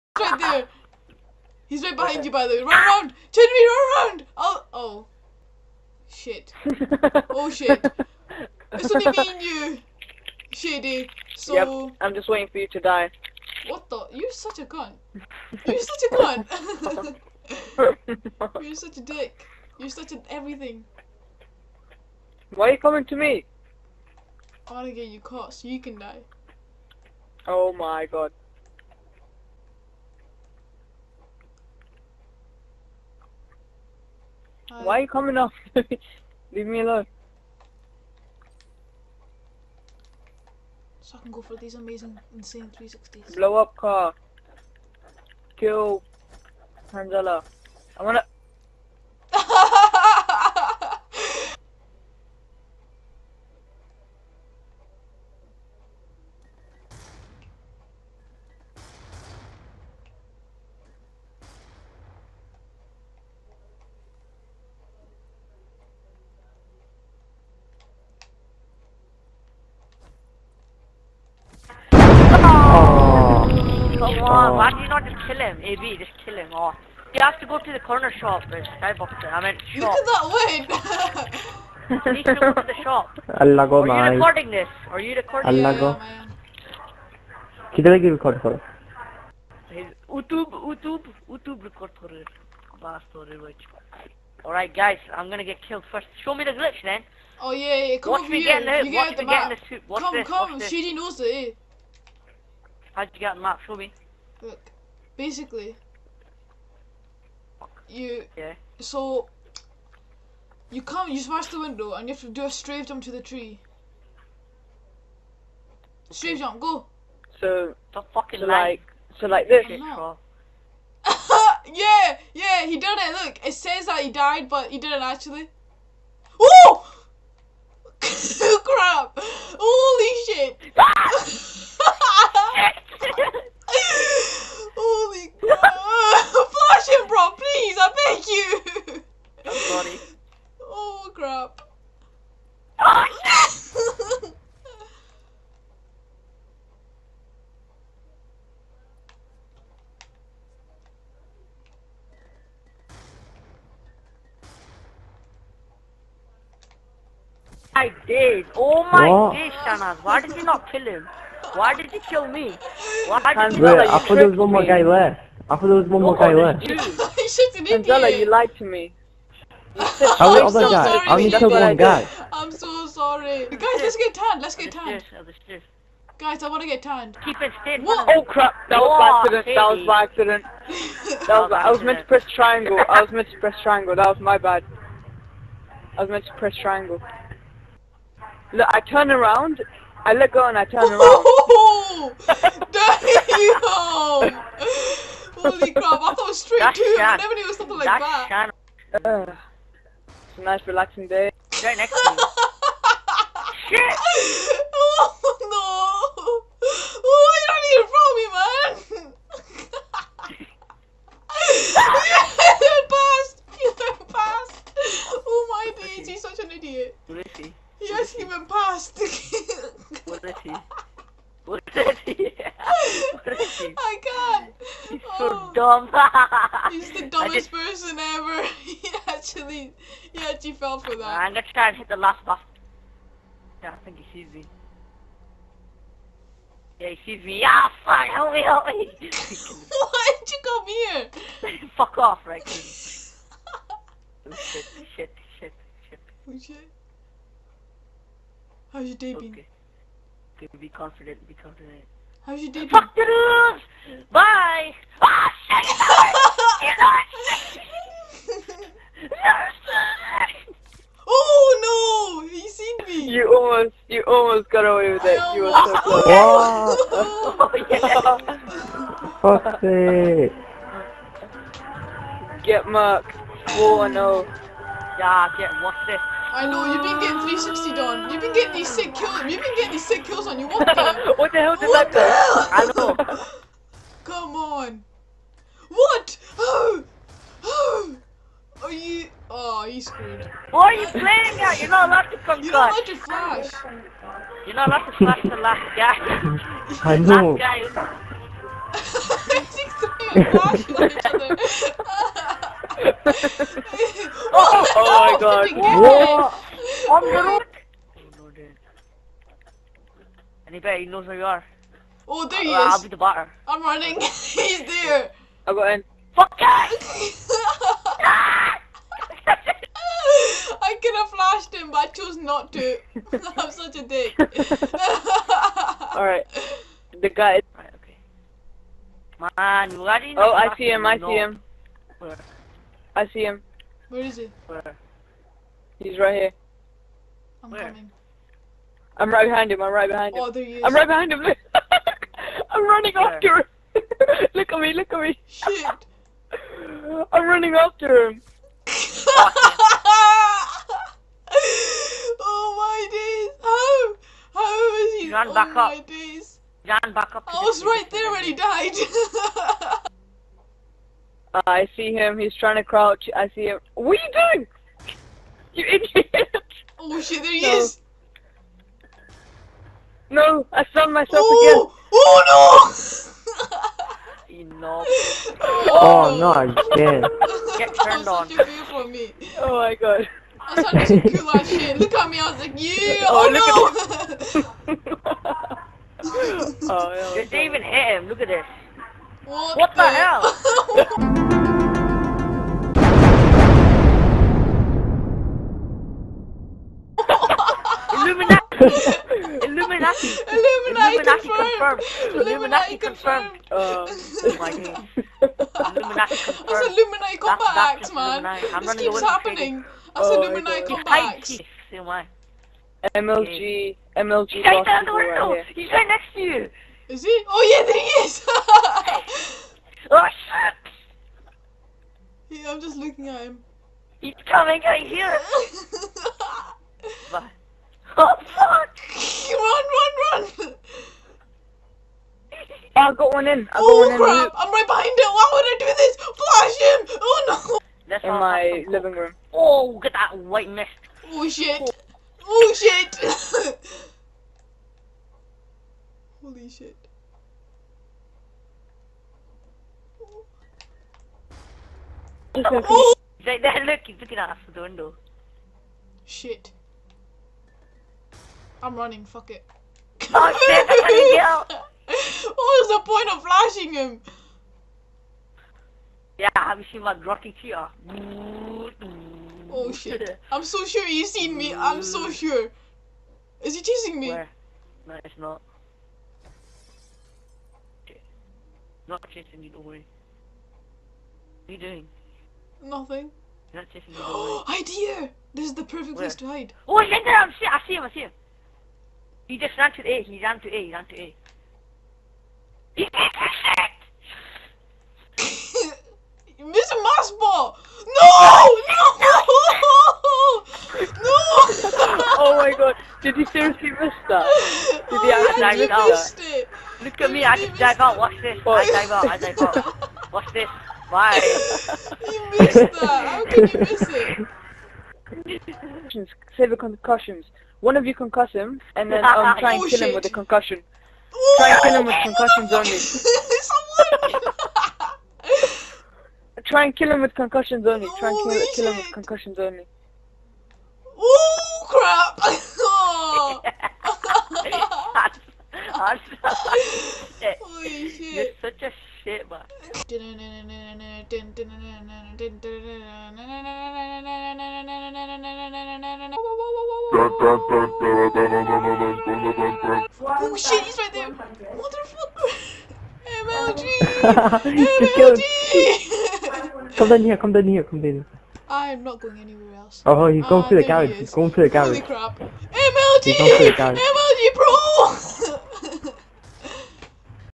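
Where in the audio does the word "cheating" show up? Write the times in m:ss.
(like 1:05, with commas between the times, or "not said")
not said.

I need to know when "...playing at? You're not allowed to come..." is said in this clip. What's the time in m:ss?
4:50.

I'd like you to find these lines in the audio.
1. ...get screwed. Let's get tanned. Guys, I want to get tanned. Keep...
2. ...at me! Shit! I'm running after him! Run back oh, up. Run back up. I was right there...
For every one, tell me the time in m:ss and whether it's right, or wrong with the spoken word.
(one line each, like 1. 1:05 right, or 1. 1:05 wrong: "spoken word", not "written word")
1. 2:53 wrong: "tanned", not "screwed"
2. 5:44 right.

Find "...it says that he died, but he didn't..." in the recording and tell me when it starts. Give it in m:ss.
2:03.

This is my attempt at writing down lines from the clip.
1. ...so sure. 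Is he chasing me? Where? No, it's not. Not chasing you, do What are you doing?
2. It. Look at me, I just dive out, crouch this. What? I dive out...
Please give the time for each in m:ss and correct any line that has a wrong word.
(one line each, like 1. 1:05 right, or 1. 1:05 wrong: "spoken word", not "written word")
1. 7:51 right
2. 8:26 wrong: "watch", not "crouch".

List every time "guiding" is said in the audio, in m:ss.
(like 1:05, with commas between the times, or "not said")
not said.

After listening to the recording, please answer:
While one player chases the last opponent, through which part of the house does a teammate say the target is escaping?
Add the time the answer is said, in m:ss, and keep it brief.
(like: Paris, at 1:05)
The garage, at 9:21.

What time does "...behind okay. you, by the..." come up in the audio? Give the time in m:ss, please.
0:01.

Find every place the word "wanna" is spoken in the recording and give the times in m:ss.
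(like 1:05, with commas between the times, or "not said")
0:24, 0:48.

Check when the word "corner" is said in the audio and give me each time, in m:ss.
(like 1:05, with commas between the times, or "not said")
1:17.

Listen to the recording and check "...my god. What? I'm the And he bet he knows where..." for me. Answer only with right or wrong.
right.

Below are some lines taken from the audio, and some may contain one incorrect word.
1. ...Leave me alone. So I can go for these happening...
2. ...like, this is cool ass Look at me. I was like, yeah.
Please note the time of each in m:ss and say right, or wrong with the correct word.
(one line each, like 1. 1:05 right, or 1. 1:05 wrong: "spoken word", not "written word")
1. 0:36 wrong: "amazing", not "happening"
2. 6:20 right.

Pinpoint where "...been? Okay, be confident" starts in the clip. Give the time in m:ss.
4:09.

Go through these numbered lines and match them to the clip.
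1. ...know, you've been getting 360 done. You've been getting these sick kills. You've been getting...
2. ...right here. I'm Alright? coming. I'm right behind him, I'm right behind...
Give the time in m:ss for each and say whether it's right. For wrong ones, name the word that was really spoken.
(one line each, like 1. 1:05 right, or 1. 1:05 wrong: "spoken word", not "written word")
1. 4:36 right
2. 5:35 wrong: "Where", not "Alright".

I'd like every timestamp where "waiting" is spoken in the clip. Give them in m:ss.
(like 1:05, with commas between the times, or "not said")
0:12.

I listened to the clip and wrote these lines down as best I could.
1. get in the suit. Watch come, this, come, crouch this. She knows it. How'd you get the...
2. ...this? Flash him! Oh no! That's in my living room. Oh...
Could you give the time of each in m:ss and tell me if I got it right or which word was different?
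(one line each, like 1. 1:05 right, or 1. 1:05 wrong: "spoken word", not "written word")
1. 1:39 wrong: "watch", not "crouch"
2. 7:15 right.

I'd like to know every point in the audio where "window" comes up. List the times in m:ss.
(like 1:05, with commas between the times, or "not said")
1:51, 6:54, 7:34.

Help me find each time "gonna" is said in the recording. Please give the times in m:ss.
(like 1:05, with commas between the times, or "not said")
1:35, 3:51.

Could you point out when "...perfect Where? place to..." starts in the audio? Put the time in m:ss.
8:05.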